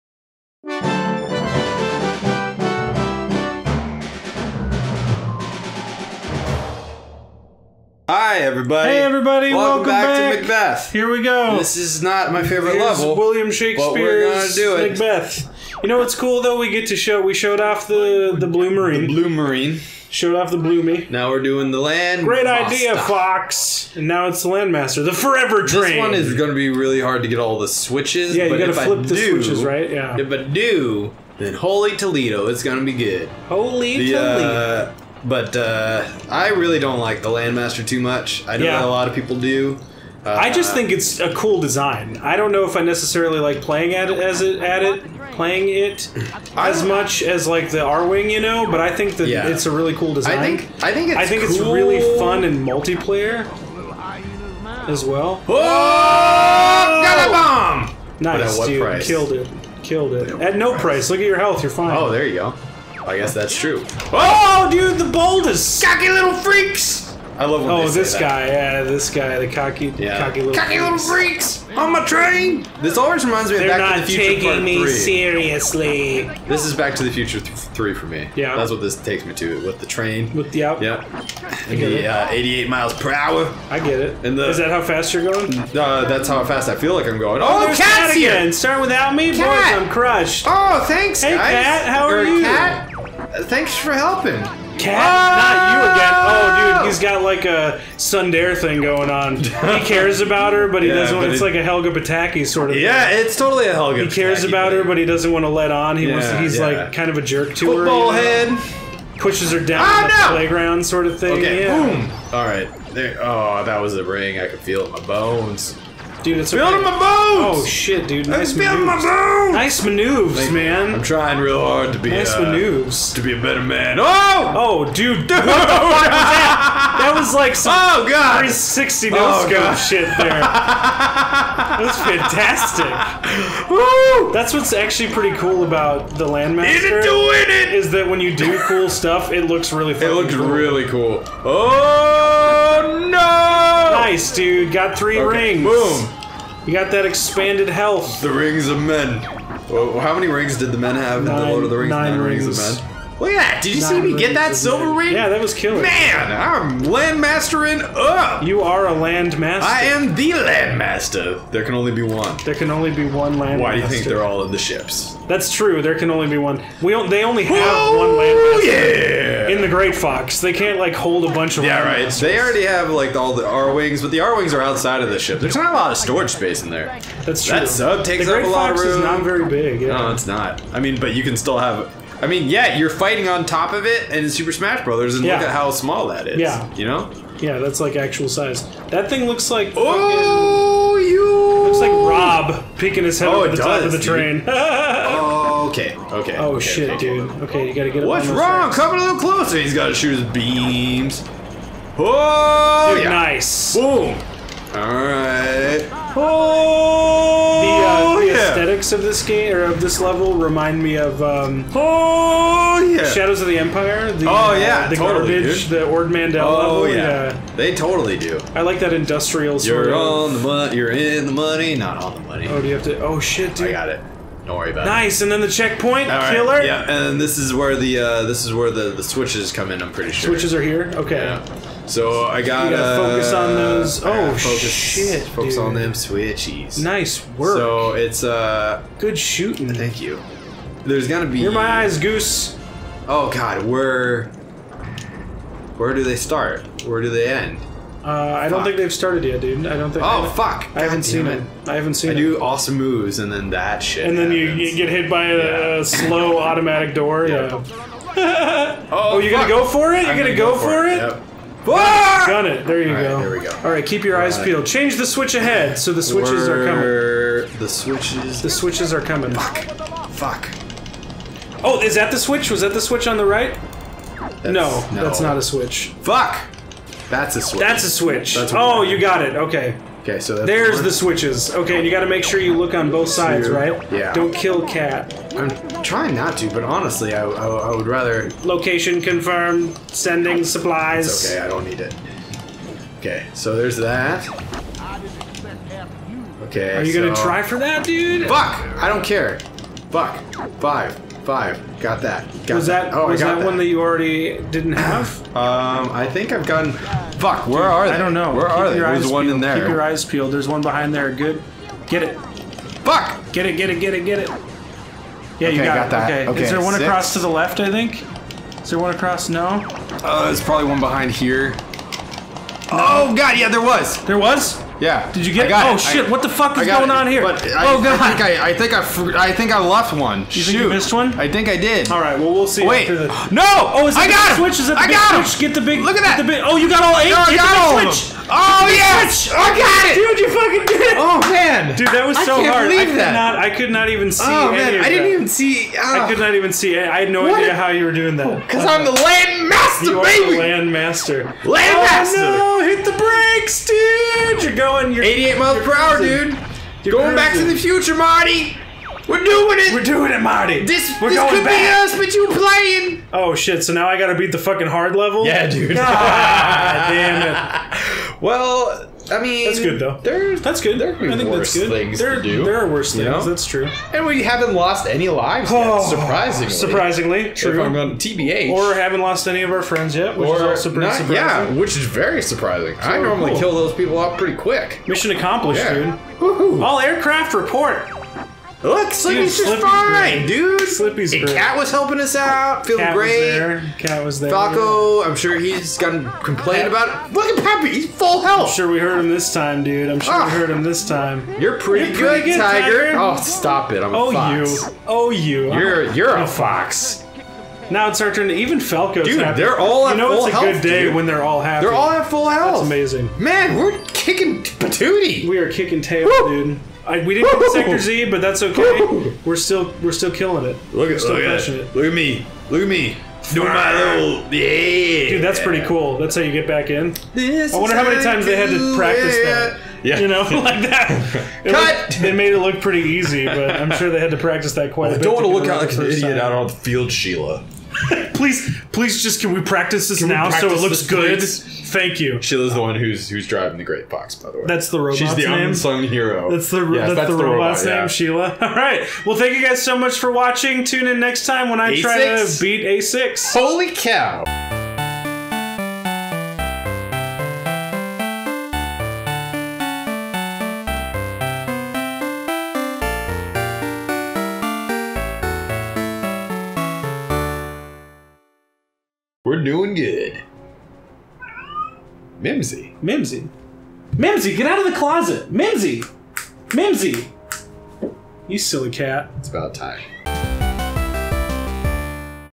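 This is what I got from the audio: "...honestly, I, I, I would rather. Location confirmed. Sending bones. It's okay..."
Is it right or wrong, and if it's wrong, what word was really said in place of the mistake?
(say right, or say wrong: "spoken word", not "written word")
wrong: "supplies", not "bones".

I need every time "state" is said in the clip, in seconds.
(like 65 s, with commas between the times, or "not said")
not said.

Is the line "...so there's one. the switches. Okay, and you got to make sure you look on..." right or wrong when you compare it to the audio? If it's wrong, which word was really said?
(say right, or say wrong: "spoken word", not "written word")
right.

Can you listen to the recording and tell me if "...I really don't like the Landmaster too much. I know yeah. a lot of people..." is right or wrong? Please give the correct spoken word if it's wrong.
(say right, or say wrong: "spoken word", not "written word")
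right.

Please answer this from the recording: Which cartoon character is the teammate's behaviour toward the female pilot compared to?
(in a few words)
Helga Pataki.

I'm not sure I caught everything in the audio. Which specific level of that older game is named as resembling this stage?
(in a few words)
Ord Mantell.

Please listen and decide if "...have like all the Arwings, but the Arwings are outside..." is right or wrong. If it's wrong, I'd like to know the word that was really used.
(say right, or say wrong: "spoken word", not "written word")
right.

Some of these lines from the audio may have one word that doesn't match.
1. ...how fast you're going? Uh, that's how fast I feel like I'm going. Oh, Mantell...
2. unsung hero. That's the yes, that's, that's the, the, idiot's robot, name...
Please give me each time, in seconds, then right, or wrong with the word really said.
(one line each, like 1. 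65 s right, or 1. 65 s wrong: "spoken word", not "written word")
1. 84 s wrong: "Katt", not "Mantell"
2. 445 s wrong: "robot", not "idiot".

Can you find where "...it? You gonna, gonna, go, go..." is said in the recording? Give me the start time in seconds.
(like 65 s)
259 s.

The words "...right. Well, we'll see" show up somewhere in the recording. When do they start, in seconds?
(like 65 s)
332 s.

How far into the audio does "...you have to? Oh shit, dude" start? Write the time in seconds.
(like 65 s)
222 s.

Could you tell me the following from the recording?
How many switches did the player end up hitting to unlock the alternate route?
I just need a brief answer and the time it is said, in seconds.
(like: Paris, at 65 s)
8, at 336 s.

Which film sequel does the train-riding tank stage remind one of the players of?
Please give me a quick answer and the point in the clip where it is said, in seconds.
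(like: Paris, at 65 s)
Back to the Future Part Three, at 73 s.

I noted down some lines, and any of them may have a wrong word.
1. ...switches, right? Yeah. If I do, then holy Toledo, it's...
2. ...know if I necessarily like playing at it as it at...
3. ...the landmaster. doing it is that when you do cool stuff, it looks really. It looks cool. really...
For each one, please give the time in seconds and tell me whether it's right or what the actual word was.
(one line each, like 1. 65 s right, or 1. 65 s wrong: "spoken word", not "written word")
1. 29 s right
2. 42 s right
3. 136 s right.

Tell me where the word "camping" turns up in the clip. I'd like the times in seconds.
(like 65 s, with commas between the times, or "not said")
not said.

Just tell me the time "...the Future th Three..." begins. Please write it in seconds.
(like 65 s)
77 s.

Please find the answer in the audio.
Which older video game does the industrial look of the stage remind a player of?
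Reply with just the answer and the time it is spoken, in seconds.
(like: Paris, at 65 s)
Shadows of the Empire, at 213 s.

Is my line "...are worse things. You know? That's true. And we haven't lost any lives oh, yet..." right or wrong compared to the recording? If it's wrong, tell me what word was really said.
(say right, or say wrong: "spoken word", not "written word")
right.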